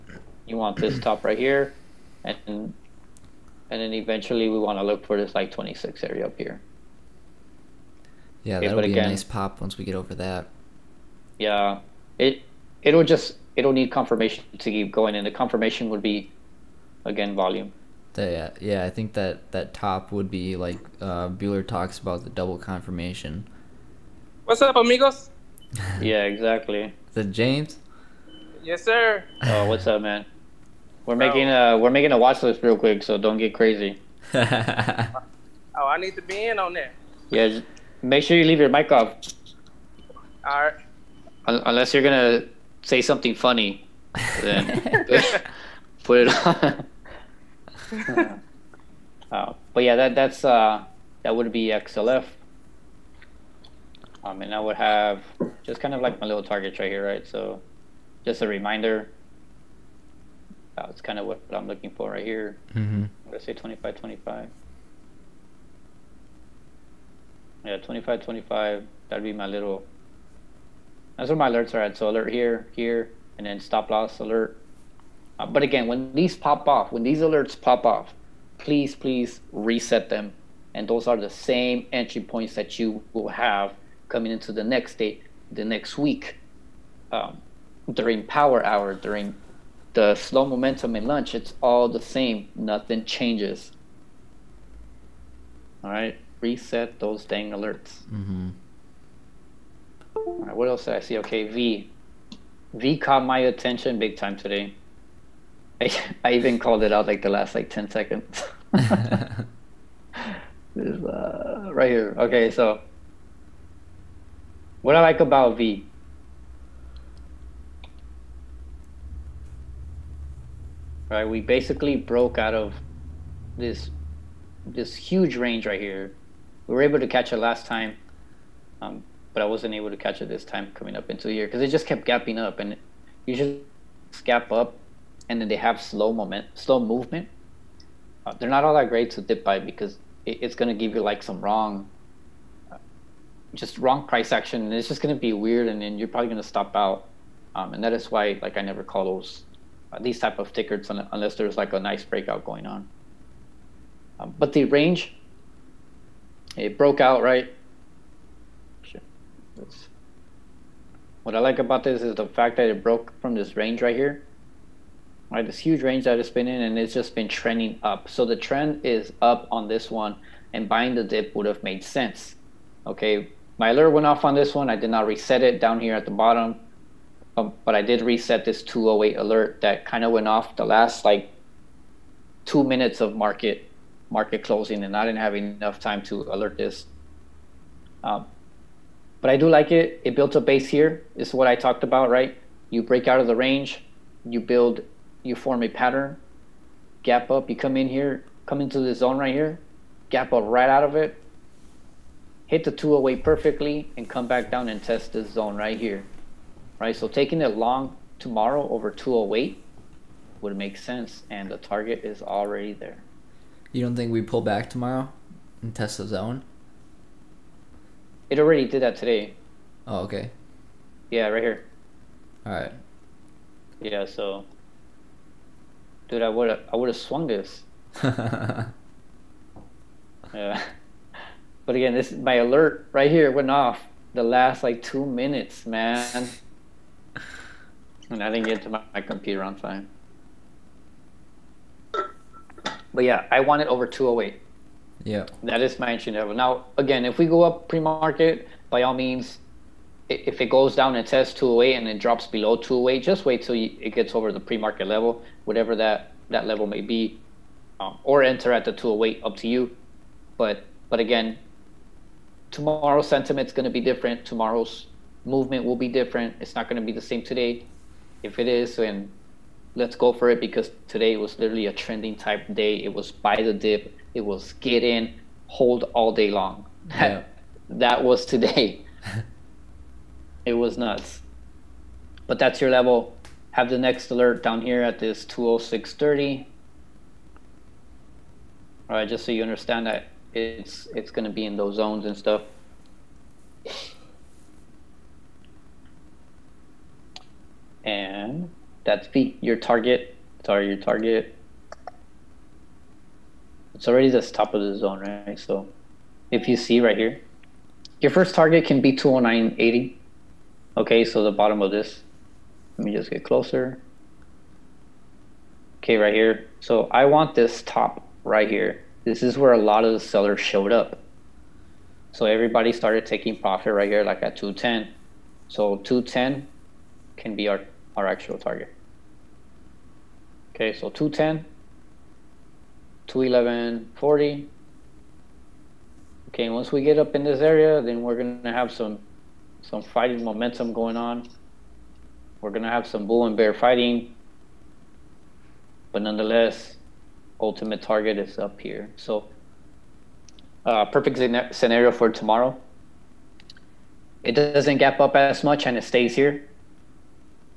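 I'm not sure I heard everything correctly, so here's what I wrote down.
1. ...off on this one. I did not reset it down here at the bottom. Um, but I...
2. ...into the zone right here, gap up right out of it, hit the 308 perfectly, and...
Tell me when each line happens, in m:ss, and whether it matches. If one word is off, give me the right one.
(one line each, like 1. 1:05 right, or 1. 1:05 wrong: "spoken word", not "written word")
1. 2:54 right
2. 3:18 wrong: "208", not "308".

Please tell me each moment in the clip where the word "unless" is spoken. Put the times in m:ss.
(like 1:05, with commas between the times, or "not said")
0:41, 2:30.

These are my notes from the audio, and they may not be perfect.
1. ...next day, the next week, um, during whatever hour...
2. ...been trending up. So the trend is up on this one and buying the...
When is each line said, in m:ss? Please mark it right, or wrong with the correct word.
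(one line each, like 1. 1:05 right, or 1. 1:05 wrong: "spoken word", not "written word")
1. 1:24 wrong: "power", not "whatever"
2. 2:47 right.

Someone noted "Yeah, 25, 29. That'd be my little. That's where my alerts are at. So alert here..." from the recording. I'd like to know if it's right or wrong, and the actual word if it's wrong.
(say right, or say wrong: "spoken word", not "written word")
wrong: "25", not "29".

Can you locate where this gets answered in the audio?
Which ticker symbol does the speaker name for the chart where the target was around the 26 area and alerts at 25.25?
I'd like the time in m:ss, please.
0:51.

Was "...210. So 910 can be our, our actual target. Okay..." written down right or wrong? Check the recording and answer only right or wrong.
wrong.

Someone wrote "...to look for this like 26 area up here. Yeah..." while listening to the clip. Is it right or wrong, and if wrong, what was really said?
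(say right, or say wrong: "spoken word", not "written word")
right.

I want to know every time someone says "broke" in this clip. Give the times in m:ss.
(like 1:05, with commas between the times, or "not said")
2:01, 2:36, 2:42.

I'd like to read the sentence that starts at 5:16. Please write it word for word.
So I want this top right here.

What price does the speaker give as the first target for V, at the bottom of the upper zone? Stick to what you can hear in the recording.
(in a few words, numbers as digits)
209.80.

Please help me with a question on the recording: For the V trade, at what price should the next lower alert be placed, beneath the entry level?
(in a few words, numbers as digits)
206.30.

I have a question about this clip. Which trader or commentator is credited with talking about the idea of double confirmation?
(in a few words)
Bueller.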